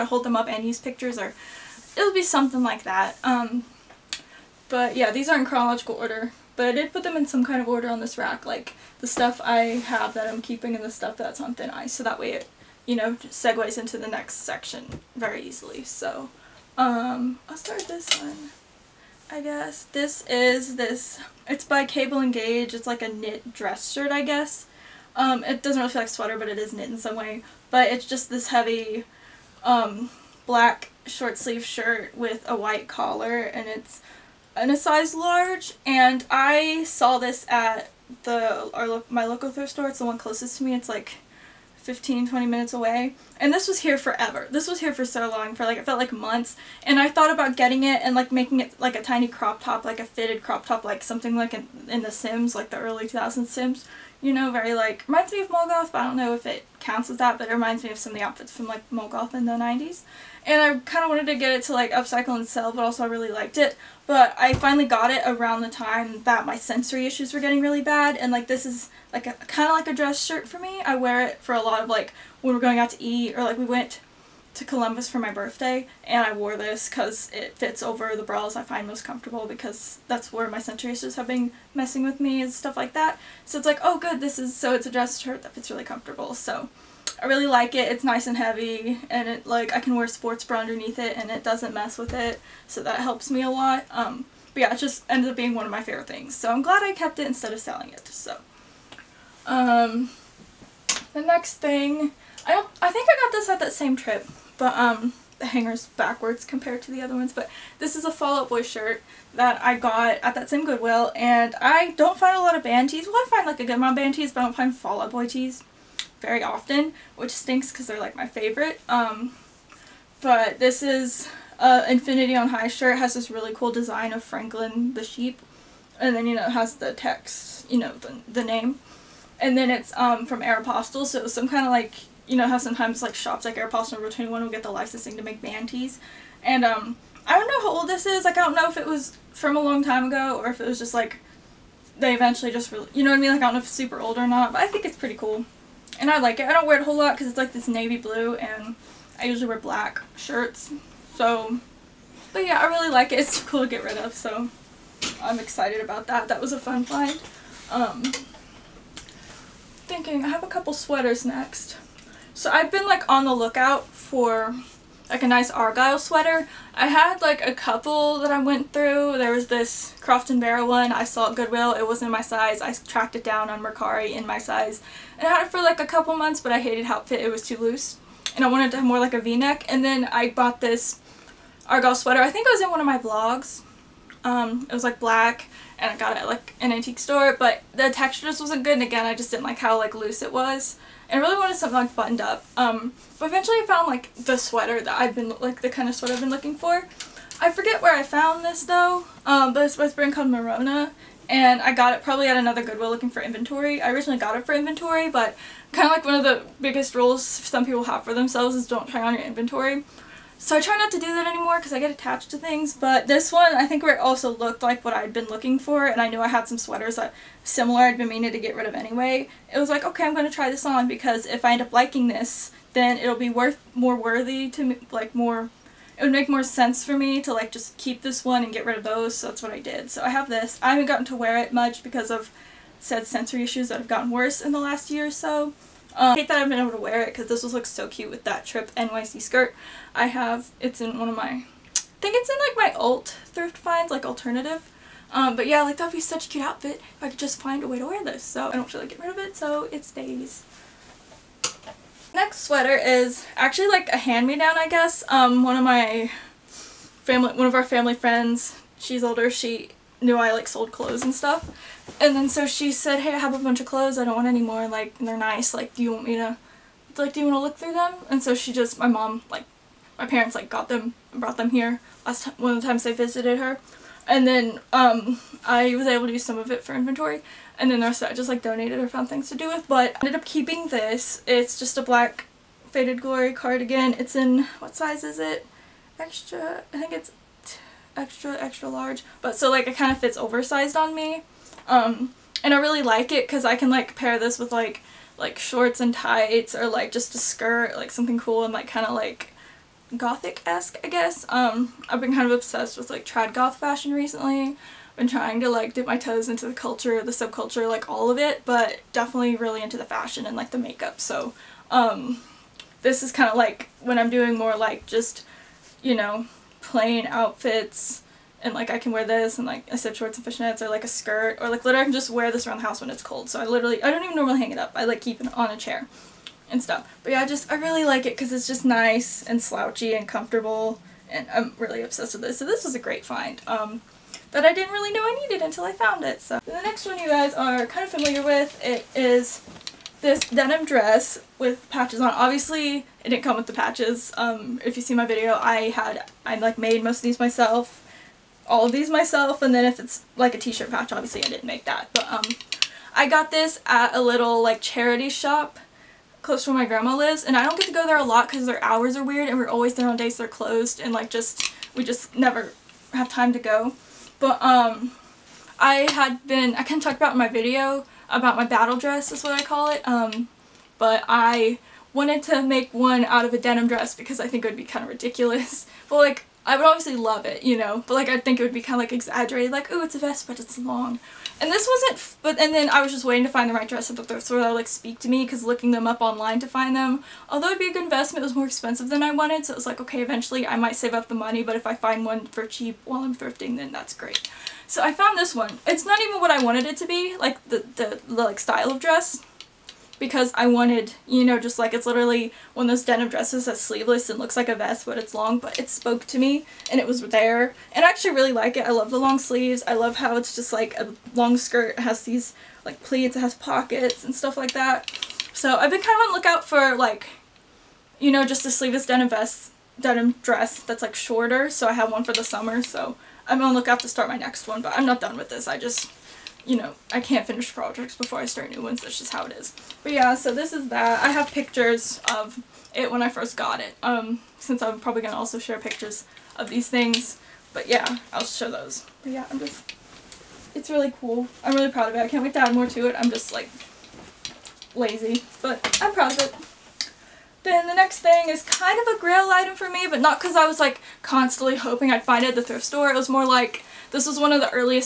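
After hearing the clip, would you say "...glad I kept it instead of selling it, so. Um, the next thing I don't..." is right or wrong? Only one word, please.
right.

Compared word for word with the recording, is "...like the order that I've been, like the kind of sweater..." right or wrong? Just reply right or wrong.
wrong.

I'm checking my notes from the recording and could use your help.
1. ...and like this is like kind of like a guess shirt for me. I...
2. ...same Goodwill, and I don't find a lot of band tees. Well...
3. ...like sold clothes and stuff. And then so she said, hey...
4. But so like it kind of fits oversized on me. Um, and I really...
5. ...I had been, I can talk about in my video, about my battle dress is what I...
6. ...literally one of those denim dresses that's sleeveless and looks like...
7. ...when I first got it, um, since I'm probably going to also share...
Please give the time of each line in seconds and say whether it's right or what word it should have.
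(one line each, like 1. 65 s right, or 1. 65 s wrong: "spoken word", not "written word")
1. 68 s wrong: "dress", not "guess"
2. 110 s right
3. 260 s right
4. 289 s right
5. 365 s right
6. 401 s right
7. 432 s right.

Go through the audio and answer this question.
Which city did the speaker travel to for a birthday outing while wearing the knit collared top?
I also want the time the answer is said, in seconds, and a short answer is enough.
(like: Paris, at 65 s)
Columbus, at 74 s.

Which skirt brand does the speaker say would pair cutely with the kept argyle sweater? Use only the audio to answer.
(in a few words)
Tripp NYC.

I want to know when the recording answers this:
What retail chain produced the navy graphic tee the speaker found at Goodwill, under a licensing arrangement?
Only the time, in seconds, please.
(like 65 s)
130 s.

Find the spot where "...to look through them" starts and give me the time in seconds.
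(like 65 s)
267 s.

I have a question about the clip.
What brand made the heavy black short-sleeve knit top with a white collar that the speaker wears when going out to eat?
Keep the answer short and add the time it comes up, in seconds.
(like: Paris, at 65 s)
Cable and Gauge, at 21 s.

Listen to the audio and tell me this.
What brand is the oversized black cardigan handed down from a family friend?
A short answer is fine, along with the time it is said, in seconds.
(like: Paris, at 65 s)
Faded Glory, at 282 s.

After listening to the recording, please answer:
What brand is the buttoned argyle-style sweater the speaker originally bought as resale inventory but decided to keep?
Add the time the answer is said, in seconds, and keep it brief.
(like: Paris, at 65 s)
Morona, at 200 s.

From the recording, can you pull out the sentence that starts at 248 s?
So I don't feel like getting rid of it, so it stays.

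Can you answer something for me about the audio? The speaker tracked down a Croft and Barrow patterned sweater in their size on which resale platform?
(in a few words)
Mercari.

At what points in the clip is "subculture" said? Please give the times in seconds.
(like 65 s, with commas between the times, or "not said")
307 s.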